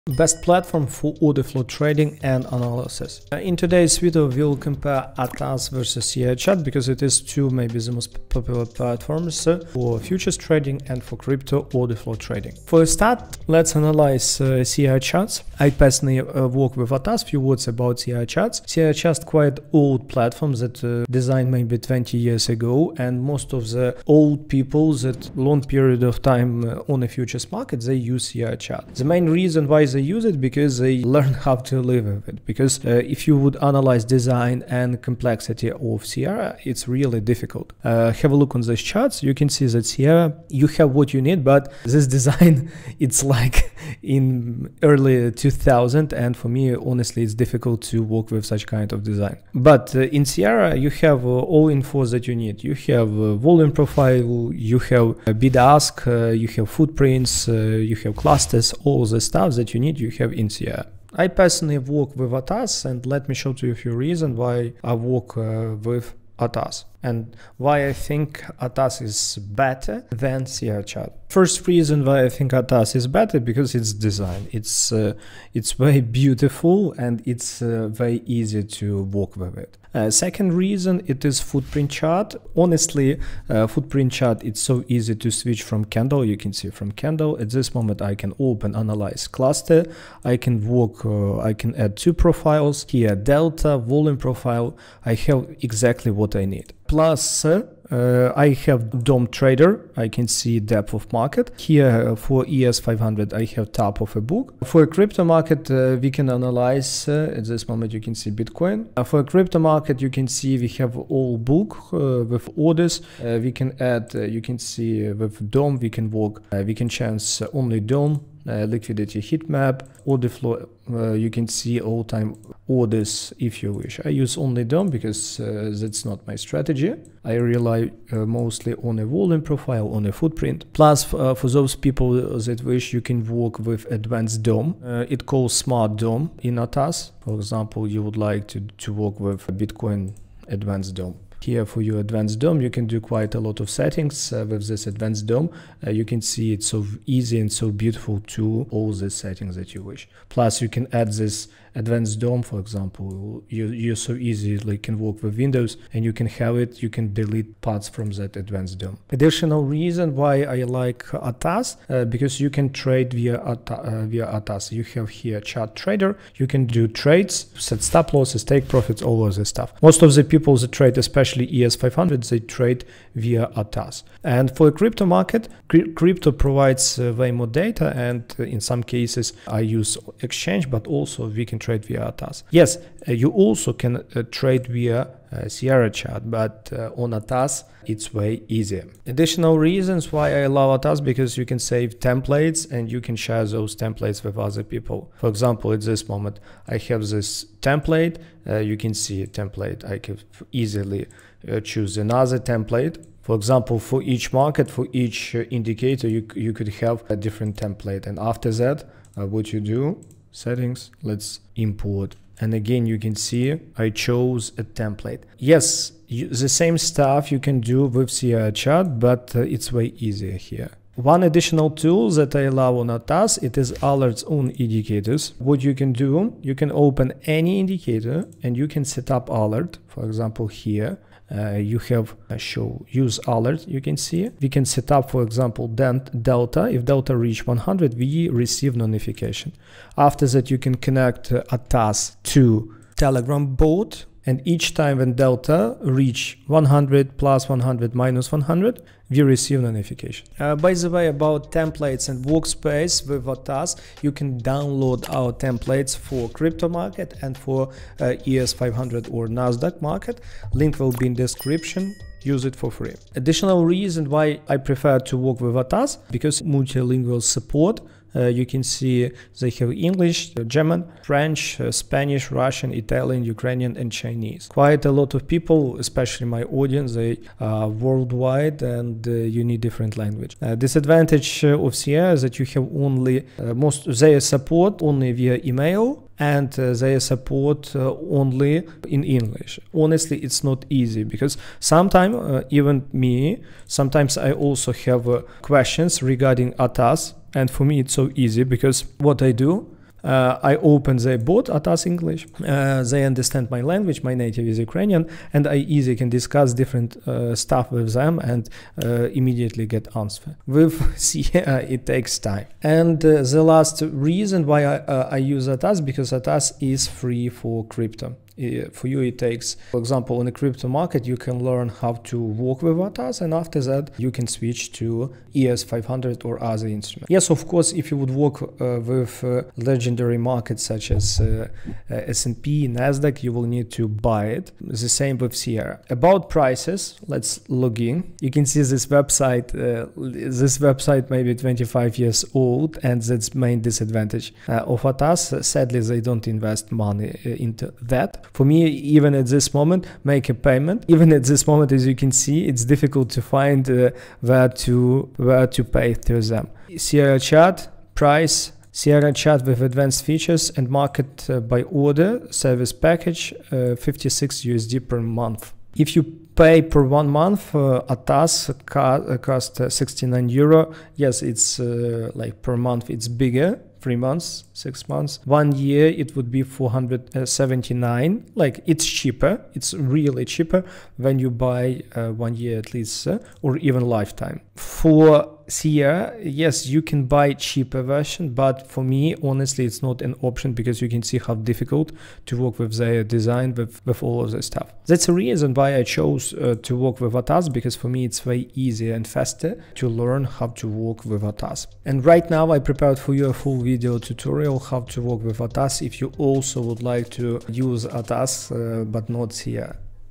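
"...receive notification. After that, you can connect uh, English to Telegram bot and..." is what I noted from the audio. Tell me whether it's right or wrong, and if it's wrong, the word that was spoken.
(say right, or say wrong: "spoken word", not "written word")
wrong: "Atas", not "English".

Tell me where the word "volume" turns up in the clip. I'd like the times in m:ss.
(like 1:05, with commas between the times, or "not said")
0:53, 1:33, 2:09.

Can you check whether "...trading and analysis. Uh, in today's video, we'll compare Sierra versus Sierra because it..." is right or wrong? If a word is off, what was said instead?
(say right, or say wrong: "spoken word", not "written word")
wrong: "Atas", not "Sierra".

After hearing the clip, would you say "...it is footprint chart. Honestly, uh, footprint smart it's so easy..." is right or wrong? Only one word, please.
wrong.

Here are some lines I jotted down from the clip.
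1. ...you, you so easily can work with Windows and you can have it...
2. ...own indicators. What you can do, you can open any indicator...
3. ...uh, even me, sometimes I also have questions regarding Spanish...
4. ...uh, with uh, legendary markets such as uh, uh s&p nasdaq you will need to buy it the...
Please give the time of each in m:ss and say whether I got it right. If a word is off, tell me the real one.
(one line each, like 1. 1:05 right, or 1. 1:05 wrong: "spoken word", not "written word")
1. 2:33 right
2. 3:44 right
3. 4:52 wrong: "ATAS", not "Spanish"
4. 5:28 right.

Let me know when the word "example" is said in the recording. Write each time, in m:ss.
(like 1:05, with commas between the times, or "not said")
2:17, 2:32, 3:15, 3:23, 3:50, 3:55, 5:19.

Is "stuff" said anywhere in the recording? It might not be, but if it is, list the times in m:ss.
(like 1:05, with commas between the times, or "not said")
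0:59, 2:49, 3:36, 5:07, 6:34.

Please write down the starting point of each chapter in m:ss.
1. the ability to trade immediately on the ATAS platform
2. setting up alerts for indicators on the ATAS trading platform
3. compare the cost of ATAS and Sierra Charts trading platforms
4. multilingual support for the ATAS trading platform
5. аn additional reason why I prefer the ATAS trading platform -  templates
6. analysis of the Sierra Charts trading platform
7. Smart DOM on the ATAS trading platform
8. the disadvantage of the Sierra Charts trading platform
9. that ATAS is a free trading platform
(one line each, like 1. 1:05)
1. 2:40
2. 3:40
3. 5:35
4. 4:25
5. 3:10
6. 0:15
7. 2:10
8. 4:40
9. 5:10.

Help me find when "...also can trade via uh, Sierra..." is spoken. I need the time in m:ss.
3:03.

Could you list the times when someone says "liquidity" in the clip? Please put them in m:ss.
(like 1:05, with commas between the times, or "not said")
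1:58.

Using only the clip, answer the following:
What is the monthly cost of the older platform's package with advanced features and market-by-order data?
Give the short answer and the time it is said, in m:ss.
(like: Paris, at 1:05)
56 USD, at 6:03.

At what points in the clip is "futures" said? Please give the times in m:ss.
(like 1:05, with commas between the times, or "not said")
0:09, 0:27.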